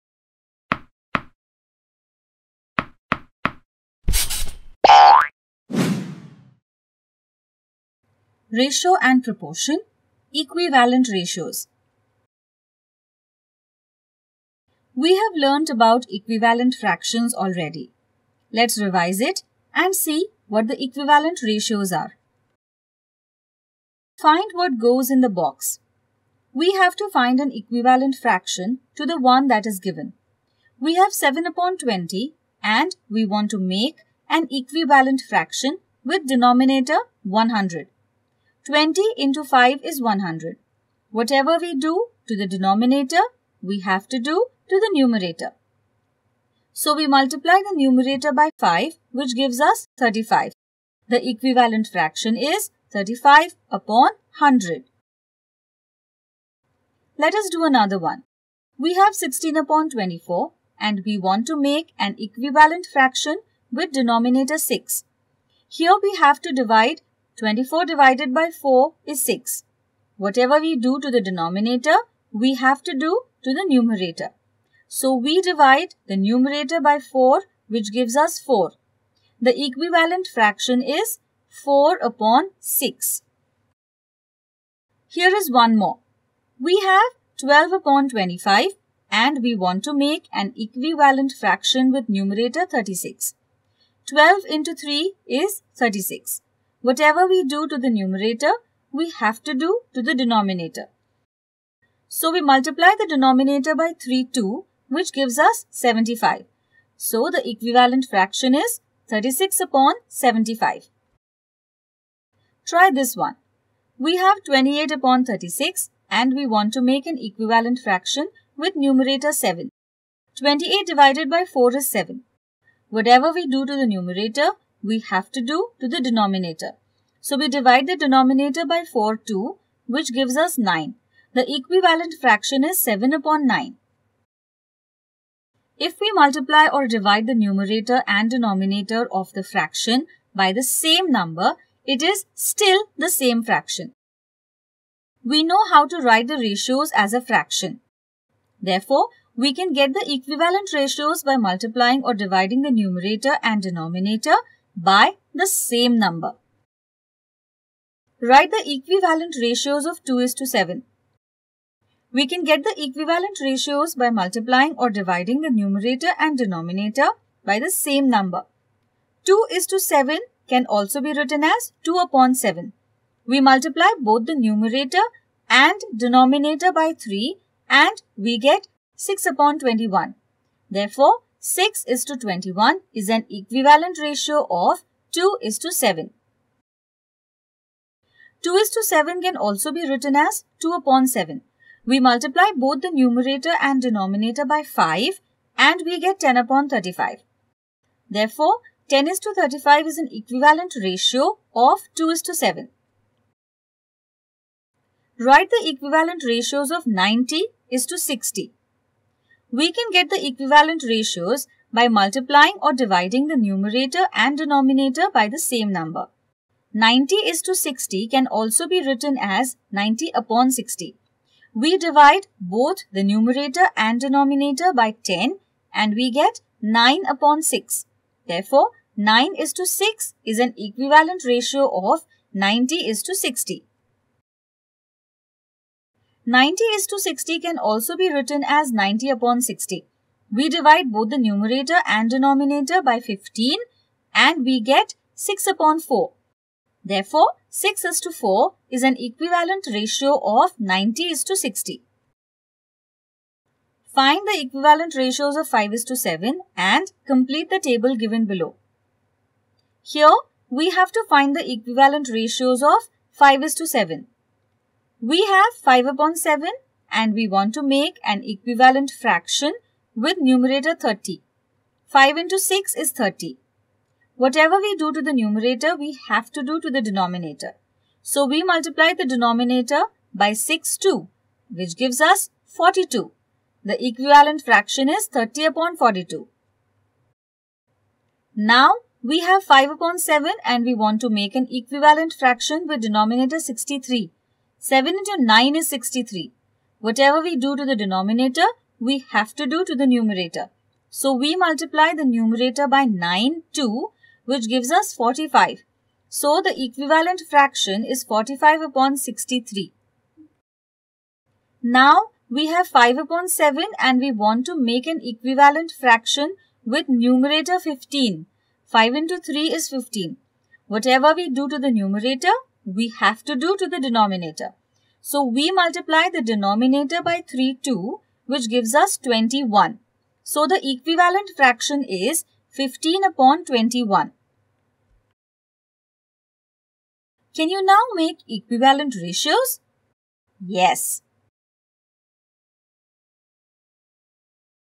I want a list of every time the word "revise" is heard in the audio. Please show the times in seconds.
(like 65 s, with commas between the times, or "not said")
18 s.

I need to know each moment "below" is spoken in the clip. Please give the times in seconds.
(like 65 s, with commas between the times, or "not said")
258 s.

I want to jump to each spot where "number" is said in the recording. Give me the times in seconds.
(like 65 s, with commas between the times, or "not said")
141 s, 155 s, 168 s, 215 s.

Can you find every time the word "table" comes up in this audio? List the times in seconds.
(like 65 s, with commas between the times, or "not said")
257 s.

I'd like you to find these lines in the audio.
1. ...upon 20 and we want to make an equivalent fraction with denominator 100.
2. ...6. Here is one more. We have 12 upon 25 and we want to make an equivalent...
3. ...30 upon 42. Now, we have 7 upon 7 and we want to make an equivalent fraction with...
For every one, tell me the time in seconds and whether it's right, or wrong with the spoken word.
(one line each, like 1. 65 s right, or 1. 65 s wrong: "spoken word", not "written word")
1. 31 s right
2. 82 s right
3. 285 s wrong: "5", not "7".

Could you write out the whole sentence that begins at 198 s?
Therefore, 10 is to 35 is an equivalent ratio of 2 is to 7.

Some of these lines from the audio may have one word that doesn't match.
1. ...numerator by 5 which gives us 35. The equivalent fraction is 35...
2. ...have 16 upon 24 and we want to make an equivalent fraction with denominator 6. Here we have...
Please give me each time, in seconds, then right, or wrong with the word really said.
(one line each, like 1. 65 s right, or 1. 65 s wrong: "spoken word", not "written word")
1. 47 s right
2. 58 s right.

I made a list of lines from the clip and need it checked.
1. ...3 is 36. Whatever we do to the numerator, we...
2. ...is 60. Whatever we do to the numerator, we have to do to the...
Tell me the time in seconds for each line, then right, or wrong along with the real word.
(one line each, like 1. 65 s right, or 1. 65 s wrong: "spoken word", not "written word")
1. 94 s right
2. 272 s wrong: "30", not "60".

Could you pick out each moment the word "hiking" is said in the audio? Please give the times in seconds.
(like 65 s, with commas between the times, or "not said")
not said.